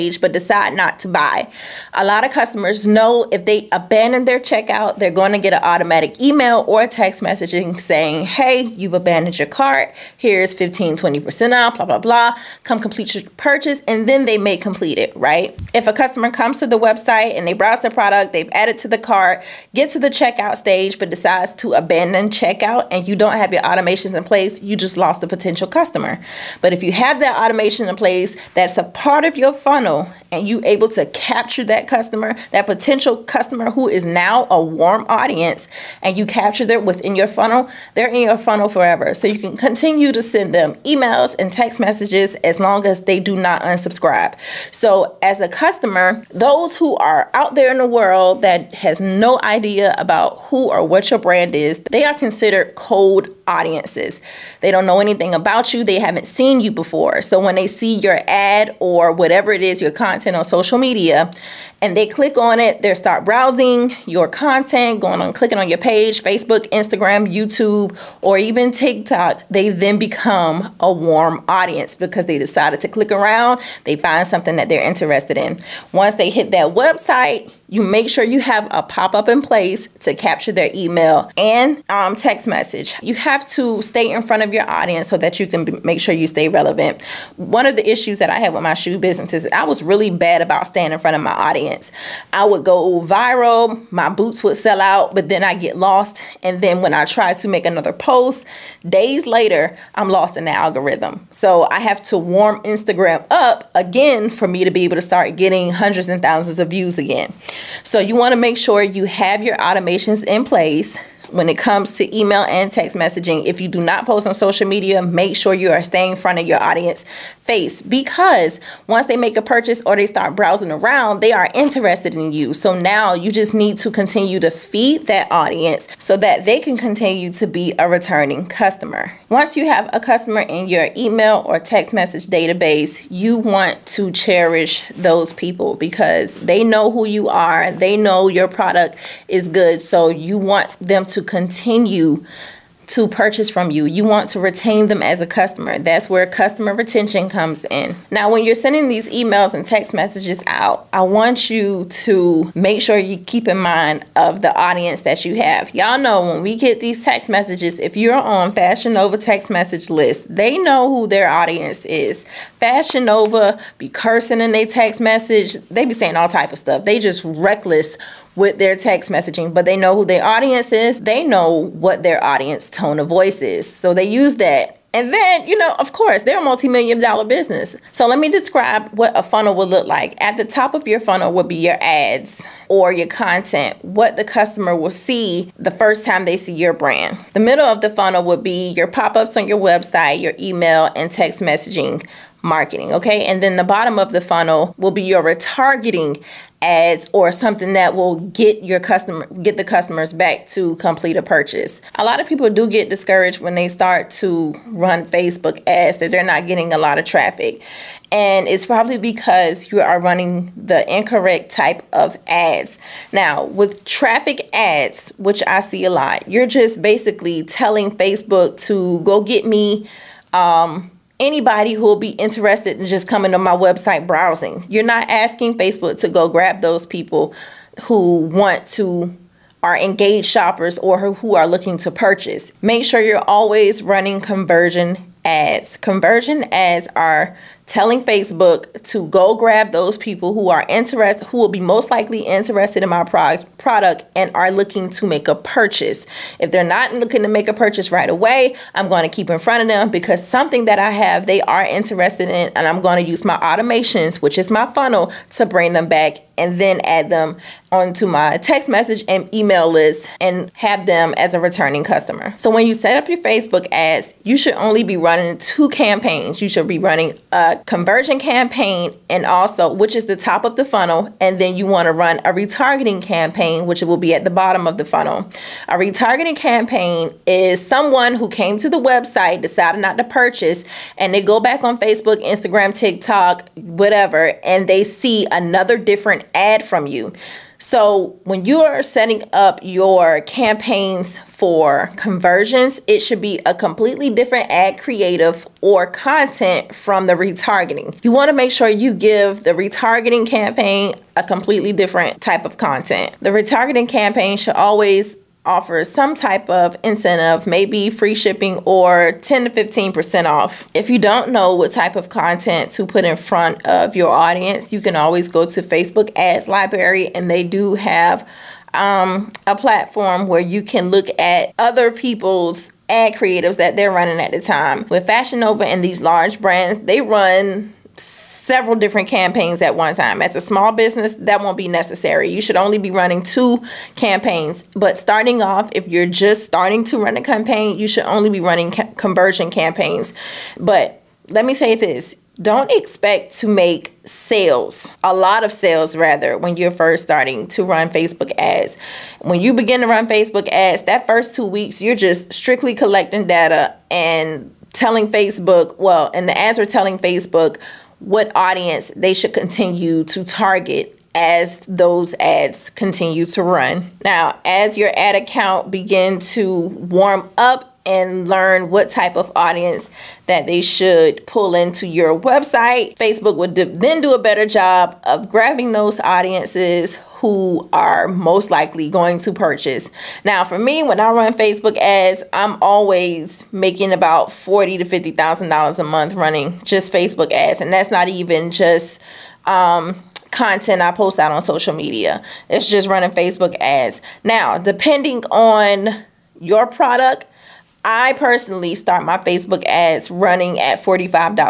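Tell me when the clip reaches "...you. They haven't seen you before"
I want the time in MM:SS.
00:55.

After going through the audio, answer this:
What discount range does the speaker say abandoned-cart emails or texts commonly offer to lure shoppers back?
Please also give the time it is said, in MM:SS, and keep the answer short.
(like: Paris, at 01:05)
15, 20% off, at 00:10.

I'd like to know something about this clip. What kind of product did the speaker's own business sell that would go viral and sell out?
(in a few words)
Boots.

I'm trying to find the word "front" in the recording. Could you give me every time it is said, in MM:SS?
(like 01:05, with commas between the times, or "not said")
01:24, 01:30, 01:56, 04:09, 05:13.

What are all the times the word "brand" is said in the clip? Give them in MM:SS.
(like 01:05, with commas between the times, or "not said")
00:51, 03:06, 05:26.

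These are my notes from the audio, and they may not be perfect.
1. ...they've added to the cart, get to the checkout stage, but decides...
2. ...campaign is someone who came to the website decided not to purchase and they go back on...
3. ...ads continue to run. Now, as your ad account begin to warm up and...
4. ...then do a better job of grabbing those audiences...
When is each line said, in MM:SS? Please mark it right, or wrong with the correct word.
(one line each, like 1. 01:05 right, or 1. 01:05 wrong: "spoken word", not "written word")
1. 00:18 right
2. 04:36 right
3. 06:02 right
4. 06:13 right.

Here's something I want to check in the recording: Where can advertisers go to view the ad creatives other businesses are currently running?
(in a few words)
Facebook Ads Library.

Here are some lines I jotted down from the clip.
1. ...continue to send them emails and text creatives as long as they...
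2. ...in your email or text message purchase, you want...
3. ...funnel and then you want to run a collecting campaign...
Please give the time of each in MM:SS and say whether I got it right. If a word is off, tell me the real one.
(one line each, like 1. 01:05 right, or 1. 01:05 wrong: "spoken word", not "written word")
1. 00:39 wrong: "messages", not "creatives"
2. 02:10 wrong: "database", not "purchase"
3. 04:30 wrong: "retargeting", not "collecting".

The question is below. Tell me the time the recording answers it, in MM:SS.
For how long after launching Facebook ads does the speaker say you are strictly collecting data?
05:51.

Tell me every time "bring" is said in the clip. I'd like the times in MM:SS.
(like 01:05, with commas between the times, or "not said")
04:15.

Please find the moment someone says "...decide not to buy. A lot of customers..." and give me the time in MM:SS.
00:00.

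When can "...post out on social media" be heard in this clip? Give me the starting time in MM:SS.
06:30.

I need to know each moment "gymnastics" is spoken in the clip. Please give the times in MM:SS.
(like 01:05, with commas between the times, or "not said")
not said.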